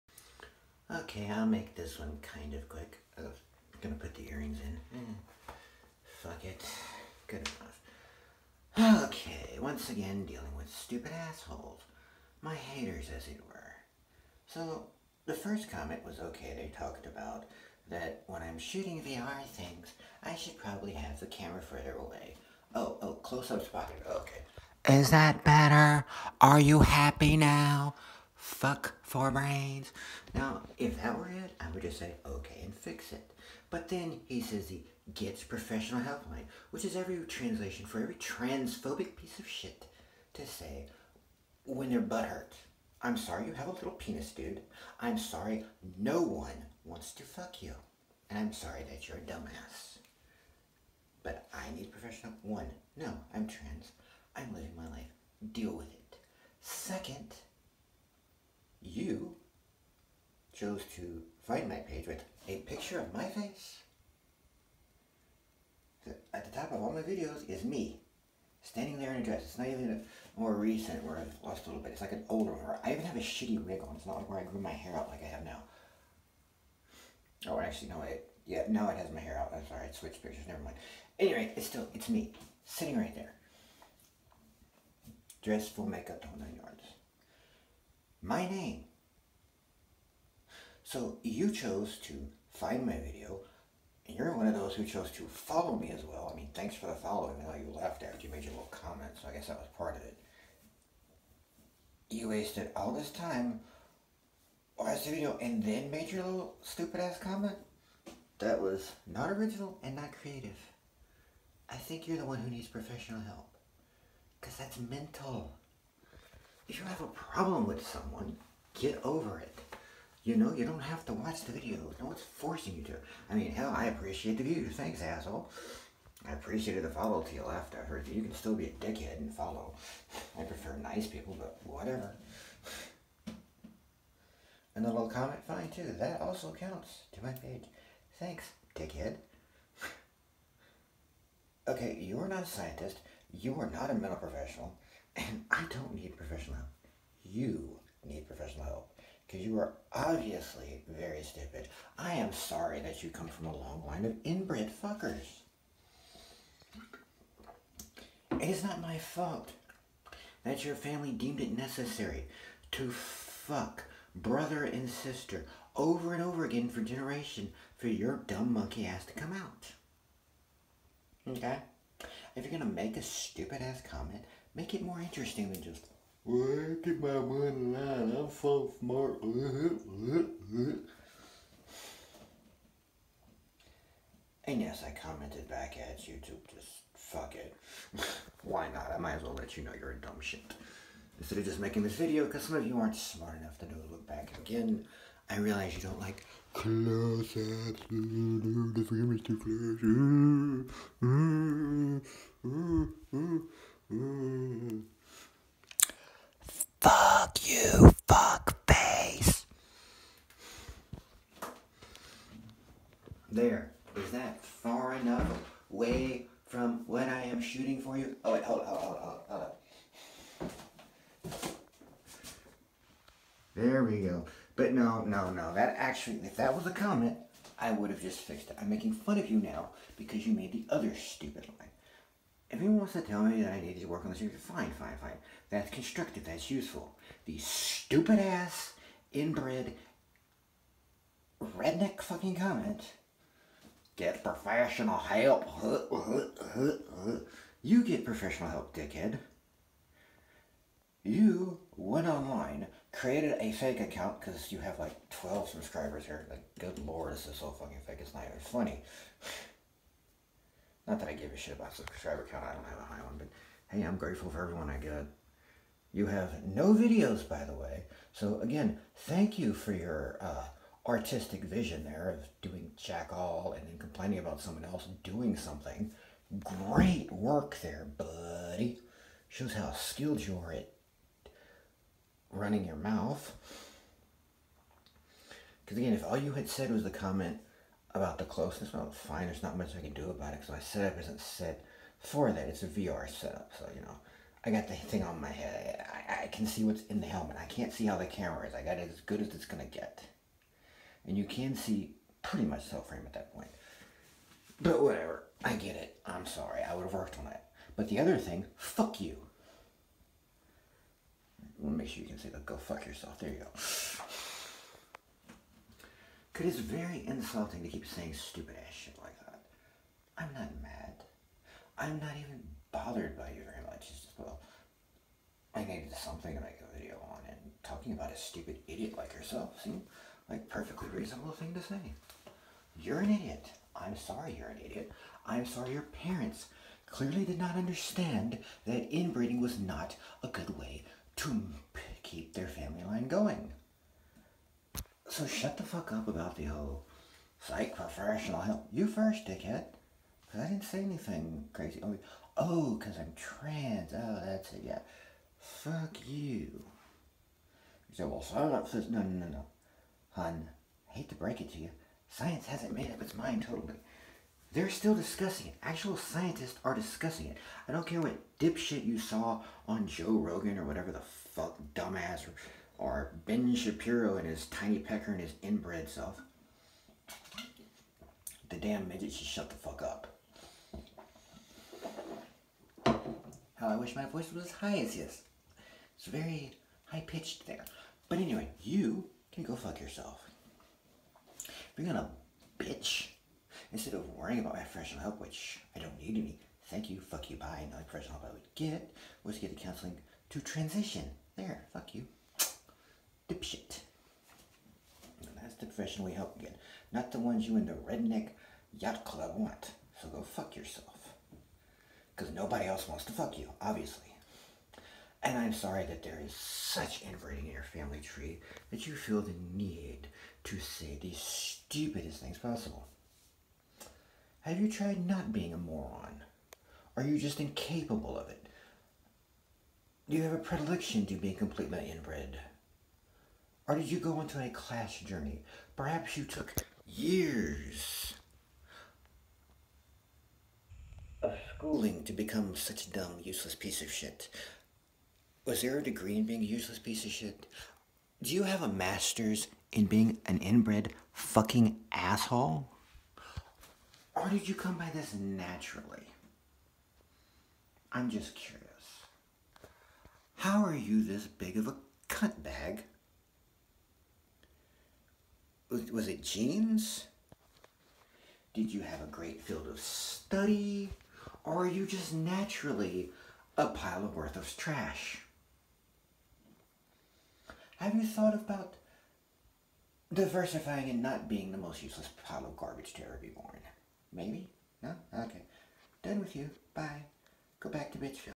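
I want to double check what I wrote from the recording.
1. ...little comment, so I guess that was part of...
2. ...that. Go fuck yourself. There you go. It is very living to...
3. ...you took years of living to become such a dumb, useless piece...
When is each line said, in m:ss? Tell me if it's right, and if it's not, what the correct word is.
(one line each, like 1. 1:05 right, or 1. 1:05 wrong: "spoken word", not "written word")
1. 1:38 right
2. 5:12 wrong: "insulting", not "living"
3. 7:16 wrong: "schooling", not "living".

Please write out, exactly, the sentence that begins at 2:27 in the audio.
You need professional help because you are obviously very stupid.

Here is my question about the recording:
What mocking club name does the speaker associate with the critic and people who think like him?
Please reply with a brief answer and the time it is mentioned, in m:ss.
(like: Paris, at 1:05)
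redneck yacht club, at 6:47.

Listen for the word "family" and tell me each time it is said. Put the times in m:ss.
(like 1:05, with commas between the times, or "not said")
2:40, 5:42, 6:57.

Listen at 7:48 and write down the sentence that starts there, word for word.
Did you have a great field of study?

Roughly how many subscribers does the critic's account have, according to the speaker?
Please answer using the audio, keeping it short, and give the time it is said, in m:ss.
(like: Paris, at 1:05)
12, at 4:15.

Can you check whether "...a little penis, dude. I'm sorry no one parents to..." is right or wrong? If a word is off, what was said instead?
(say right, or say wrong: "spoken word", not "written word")
wrong: "wants", not "parents".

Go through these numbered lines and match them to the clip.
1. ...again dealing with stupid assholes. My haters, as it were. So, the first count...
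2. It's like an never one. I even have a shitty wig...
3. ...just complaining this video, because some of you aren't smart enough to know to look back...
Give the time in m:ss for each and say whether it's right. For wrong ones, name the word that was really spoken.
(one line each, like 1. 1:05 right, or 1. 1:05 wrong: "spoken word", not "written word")
1. 0:09 wrong: "comment", not "count"
2. 1:11 wrong: "older", not "never"
3. 3:11 wrong: "making", not "complaining".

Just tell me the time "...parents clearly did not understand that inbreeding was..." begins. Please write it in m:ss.
5:36.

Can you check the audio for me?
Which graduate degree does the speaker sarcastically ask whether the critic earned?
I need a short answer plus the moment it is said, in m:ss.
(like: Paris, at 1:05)
master's, at 7:28.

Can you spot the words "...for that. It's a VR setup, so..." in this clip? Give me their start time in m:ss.
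4:51.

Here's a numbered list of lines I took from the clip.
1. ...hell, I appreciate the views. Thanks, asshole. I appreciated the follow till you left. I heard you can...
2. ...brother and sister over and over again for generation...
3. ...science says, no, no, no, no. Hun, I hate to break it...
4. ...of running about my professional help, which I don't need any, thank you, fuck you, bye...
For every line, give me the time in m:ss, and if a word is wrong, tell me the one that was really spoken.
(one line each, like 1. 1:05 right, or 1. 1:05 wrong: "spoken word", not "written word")
1. 2:03 right
2. 2:44 right
3. 5:58 right
4. 6:33 wrong: "worrying", not "running".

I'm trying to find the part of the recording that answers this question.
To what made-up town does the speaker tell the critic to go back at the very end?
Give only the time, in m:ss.
8:07.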